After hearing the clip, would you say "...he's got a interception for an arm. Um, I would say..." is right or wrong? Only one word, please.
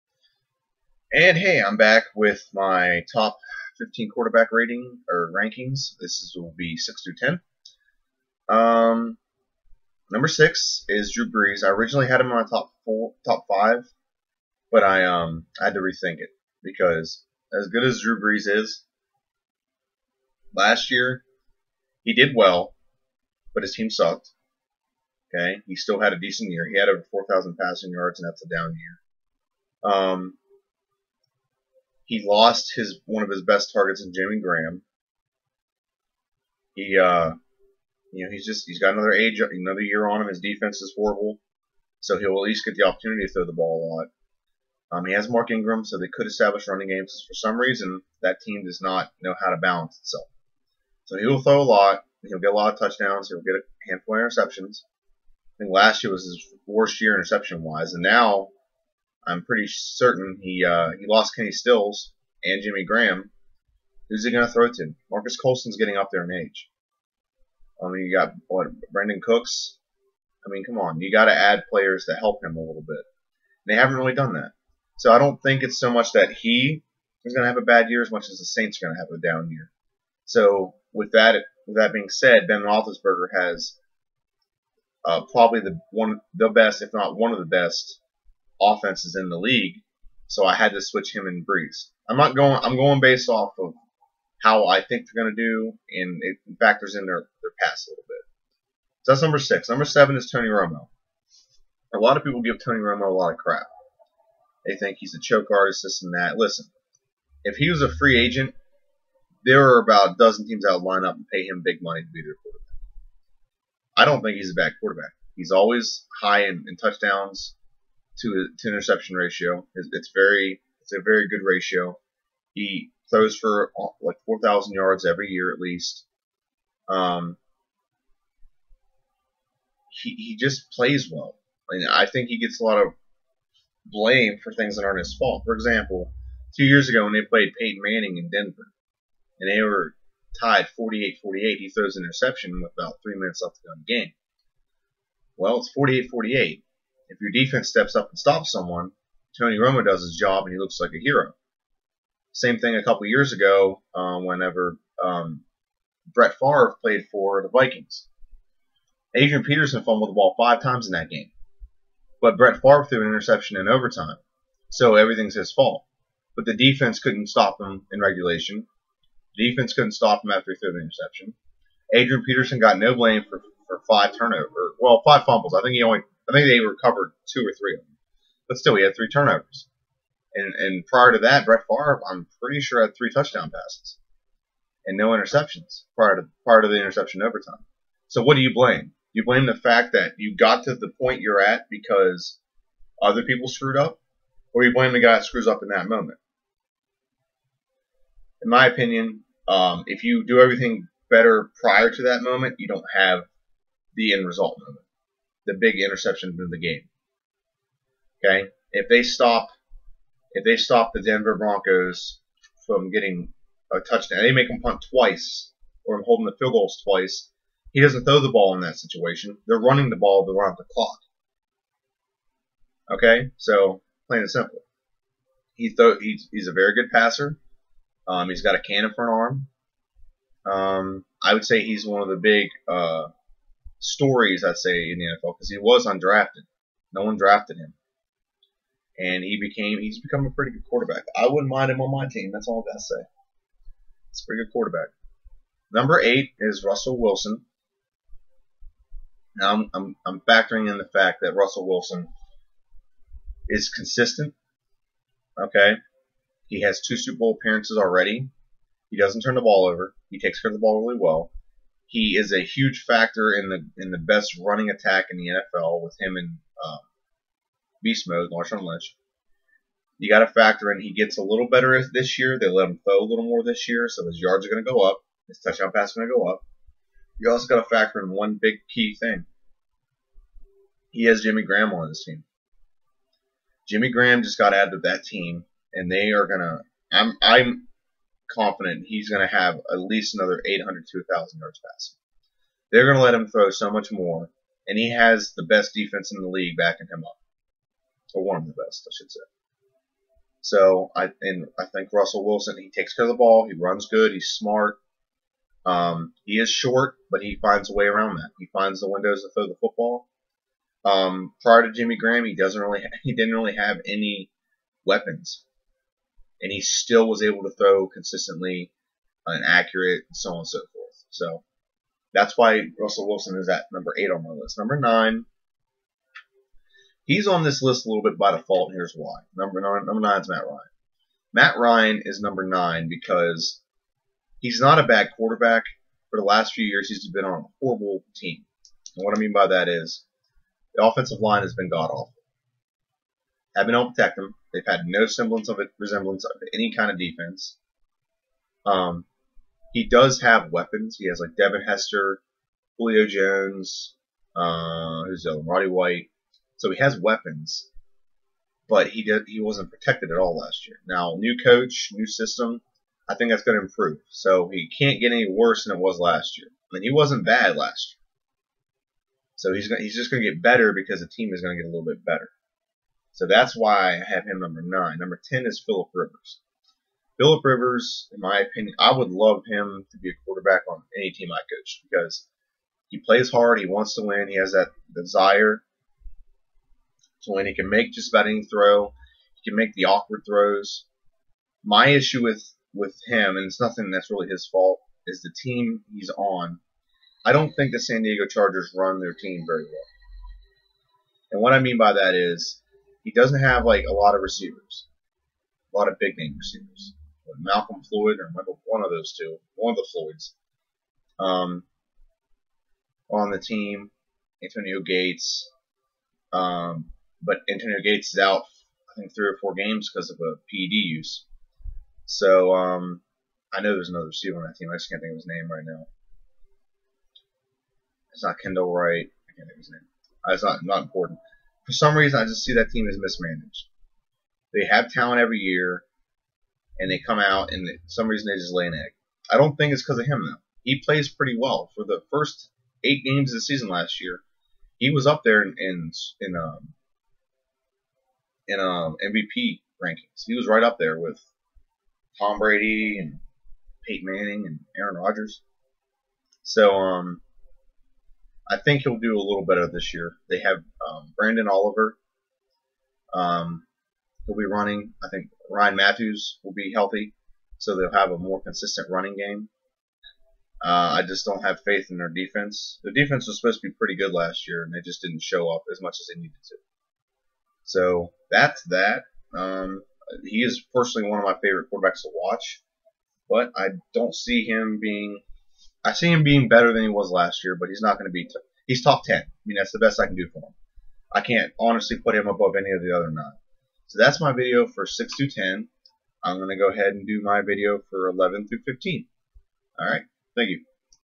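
wrong.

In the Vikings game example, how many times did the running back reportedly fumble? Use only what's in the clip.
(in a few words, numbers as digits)
5.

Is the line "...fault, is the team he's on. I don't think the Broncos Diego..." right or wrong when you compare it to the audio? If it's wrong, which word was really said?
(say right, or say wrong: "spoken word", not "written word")
wrong: "San", not "Broncos".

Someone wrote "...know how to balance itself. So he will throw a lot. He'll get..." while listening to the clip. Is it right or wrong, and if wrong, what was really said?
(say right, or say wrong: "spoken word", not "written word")
right.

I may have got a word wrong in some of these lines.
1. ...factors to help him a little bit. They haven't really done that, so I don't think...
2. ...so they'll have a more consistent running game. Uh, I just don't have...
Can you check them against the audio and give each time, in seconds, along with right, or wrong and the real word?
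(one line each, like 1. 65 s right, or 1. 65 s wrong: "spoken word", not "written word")
1. 71 s wrong: "players", not "factors"
2. 467 s right.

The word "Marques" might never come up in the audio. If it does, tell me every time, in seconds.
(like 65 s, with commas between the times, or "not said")
65 s.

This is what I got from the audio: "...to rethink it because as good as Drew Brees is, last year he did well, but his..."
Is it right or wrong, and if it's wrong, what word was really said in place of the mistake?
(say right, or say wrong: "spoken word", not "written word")
right.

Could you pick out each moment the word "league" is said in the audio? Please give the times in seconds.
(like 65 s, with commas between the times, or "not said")
89 s, 296 s.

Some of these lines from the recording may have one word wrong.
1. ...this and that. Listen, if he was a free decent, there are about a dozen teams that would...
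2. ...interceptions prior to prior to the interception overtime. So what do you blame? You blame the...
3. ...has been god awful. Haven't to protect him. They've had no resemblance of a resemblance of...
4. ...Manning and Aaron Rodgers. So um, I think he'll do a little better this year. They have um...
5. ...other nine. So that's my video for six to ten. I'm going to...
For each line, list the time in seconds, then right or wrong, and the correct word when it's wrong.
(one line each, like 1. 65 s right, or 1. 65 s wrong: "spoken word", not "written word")
1. 105 s wrong: "agent", not "decent"
2. 185 s right
3. 341 s wrong: "semblance", not "resemblance"
4. 454 s right
5. 492 s right.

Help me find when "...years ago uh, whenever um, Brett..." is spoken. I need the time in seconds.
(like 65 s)
153 s.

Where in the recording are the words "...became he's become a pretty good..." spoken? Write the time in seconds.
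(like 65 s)
239 s.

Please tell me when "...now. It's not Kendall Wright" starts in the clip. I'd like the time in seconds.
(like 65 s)
425 s.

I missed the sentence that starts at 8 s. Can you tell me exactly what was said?
Um, number 6 is Drew Brees.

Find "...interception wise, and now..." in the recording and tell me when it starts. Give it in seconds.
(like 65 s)
57 s.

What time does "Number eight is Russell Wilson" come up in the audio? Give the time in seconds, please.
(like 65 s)
245 s.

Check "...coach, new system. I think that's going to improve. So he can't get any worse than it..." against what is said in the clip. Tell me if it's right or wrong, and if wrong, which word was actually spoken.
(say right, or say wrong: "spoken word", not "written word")
right.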